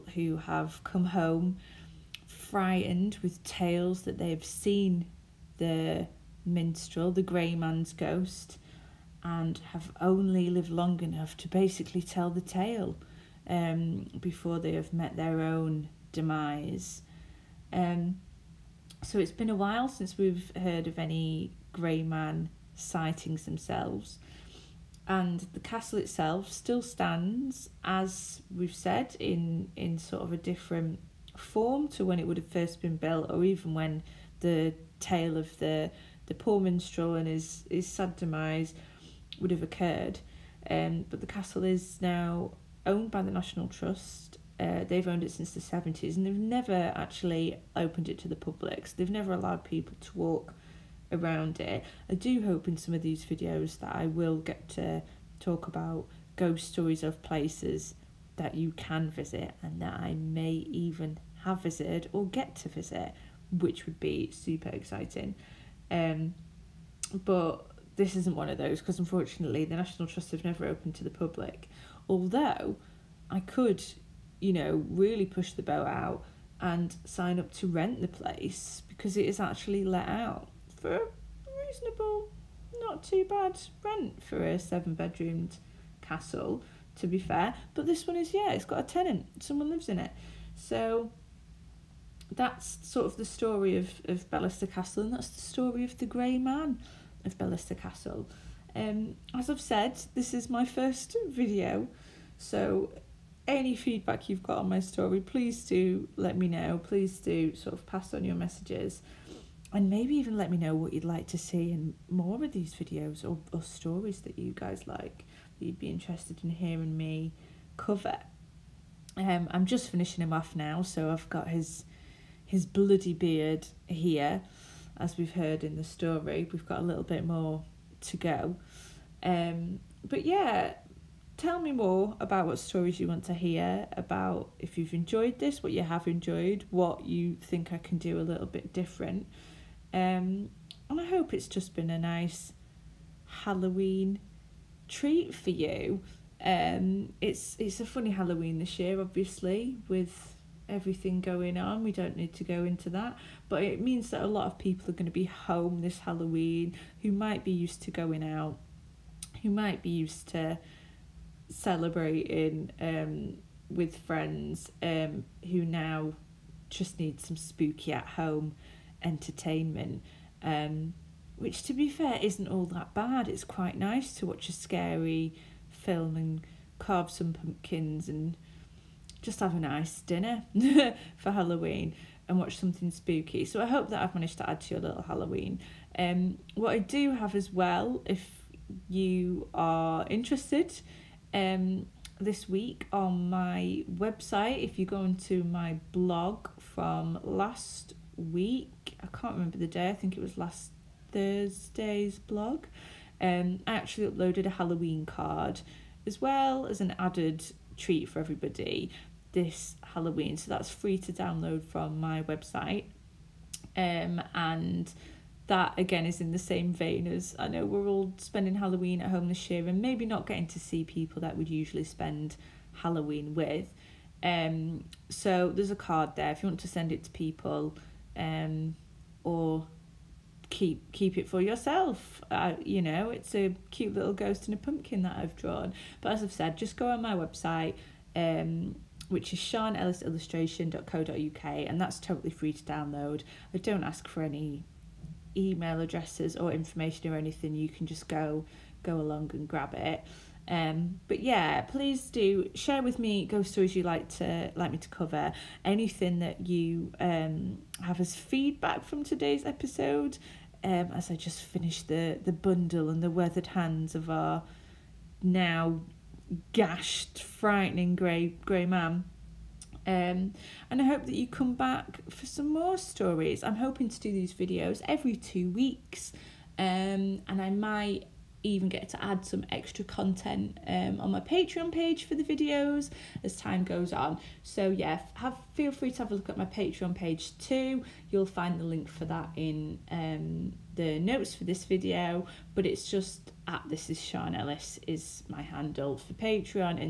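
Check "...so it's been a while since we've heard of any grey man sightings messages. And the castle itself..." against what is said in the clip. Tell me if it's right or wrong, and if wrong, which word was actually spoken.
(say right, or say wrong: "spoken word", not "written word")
wrong: "themselves", not "messages".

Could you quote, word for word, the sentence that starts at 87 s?
But this one is, yeah, it's got a tenant, someone lives in it.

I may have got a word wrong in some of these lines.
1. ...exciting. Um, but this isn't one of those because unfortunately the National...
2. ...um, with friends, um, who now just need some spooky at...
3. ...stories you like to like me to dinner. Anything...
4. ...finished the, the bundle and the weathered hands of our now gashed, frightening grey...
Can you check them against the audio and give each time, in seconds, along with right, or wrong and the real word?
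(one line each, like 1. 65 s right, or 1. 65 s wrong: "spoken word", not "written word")
1. 64 s right
2. 162 s right
3. 253 s wrong: "cover", not "dinner"
4. 261 s right.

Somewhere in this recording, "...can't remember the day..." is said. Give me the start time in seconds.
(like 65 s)
199 s.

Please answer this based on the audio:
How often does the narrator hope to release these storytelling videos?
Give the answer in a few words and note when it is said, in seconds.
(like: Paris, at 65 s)
Every two weeks, at 274 s.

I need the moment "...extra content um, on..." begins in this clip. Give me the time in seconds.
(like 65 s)
279 s.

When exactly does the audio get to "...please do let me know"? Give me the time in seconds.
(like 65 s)
105 s.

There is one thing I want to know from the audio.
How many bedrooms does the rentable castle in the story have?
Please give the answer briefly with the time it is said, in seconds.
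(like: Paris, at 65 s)
7, at 84 s.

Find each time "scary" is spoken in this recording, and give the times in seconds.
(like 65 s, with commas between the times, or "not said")
174 s.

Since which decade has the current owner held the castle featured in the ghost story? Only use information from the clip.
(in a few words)
1970s.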